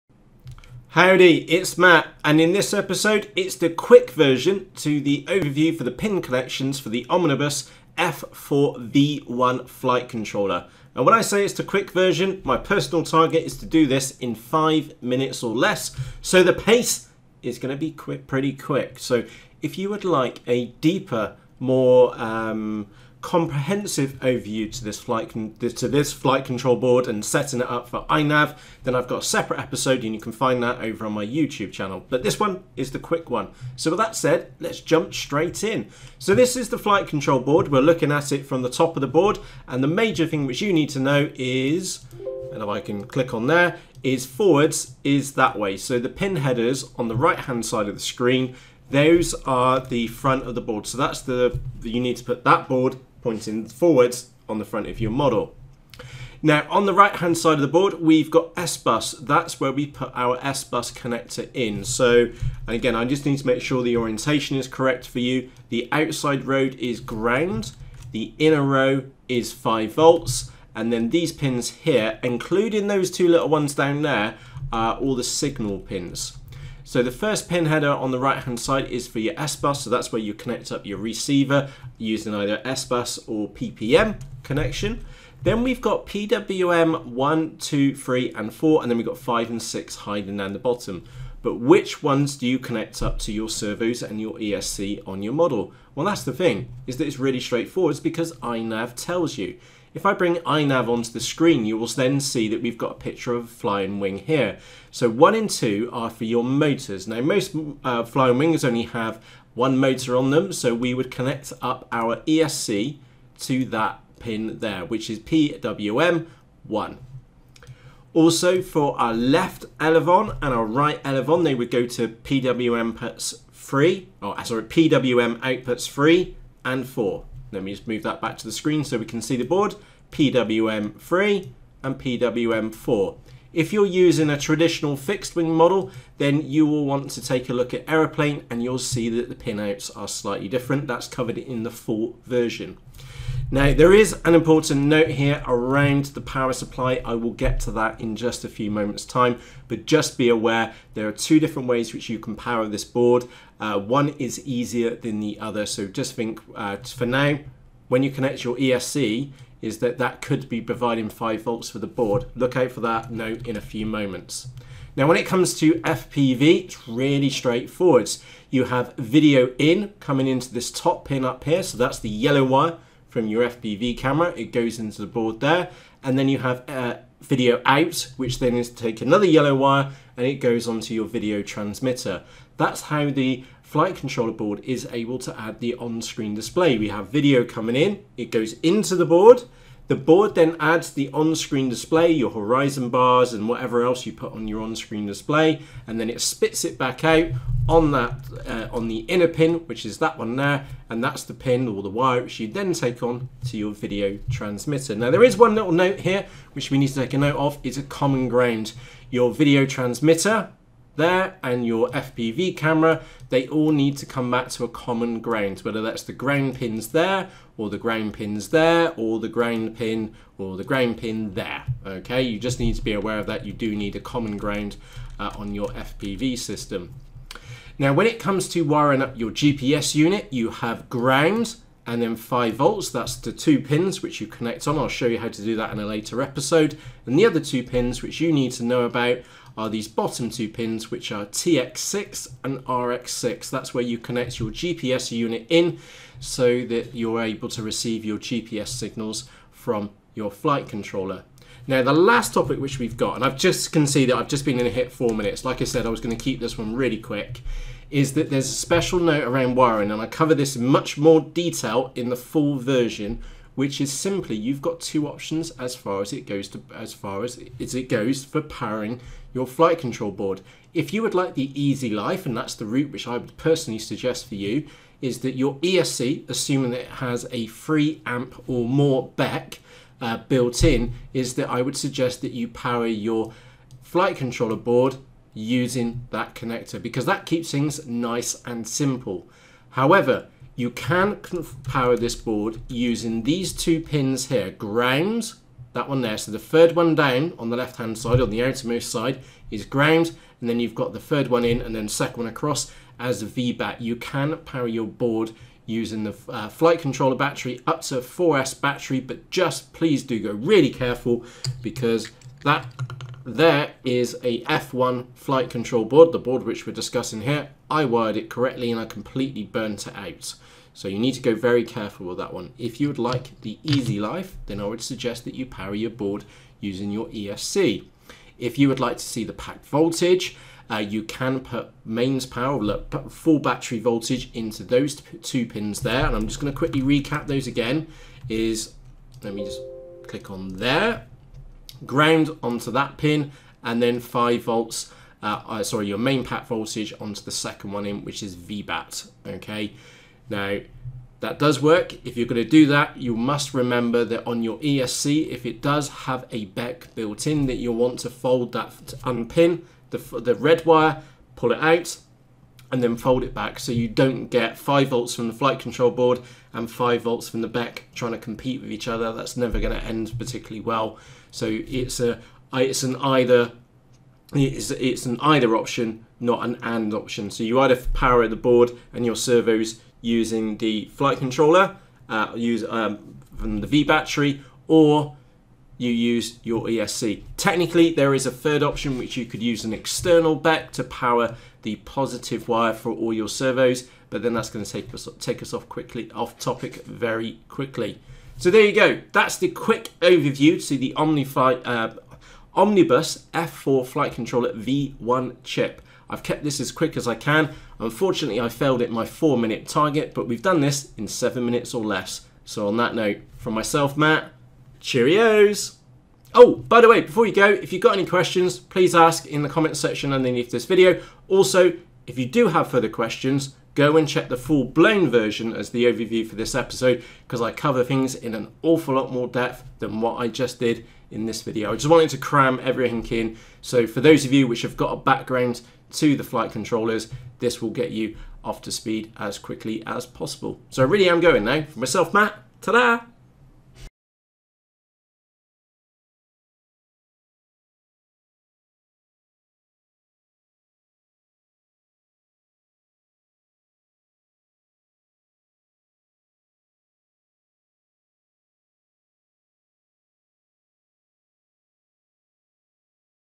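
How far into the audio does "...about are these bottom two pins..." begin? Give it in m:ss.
3:58.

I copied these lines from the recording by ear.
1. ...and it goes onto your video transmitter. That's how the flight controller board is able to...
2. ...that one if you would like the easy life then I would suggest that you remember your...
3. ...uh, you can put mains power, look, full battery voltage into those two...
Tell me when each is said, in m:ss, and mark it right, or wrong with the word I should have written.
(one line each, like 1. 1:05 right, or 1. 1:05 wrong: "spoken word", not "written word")
1. 3:00 right
2. 5:22 wrong: "power", not "remember"
3. 5:30 right.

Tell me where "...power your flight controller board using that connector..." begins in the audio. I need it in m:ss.
4:42.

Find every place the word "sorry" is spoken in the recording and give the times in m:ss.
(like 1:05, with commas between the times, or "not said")
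2:04, 5:45.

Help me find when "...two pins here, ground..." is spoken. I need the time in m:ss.
4:53.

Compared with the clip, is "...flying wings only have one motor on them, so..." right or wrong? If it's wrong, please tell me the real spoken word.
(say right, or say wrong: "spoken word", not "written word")
right.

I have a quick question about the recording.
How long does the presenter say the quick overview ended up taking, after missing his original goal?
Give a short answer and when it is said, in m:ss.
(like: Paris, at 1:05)
7 minutes or less, at 6:51.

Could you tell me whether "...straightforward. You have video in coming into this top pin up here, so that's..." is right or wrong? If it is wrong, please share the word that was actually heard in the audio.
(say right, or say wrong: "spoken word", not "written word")
right.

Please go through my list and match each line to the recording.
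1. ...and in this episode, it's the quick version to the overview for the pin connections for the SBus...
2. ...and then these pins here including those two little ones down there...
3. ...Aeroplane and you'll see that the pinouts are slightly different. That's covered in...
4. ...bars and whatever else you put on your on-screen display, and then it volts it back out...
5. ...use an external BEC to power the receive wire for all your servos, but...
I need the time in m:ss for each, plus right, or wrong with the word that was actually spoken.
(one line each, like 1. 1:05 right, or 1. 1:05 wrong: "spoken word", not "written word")
1. 0:02 wrong: "Omnibus", not "SBus"
2. 1:10 right
3. 2:17 right
4. 3:12 wrong: "spits", not "volts"
5. 6:29 wrong: "positive", not "receive".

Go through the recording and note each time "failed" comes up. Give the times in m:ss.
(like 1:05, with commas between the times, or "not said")
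6:48.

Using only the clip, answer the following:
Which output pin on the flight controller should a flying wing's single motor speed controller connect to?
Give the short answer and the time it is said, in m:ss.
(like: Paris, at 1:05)
PWM1, at 1:55.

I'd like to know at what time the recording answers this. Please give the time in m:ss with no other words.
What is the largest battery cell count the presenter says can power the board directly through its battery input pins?
5:07.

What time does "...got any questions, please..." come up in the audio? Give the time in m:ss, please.
6:57.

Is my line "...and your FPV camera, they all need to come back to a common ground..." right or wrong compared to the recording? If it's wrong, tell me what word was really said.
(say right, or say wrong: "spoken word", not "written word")
right.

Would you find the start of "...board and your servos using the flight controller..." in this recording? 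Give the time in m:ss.
6:18.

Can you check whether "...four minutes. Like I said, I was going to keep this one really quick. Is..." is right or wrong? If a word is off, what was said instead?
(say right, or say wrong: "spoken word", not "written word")
right.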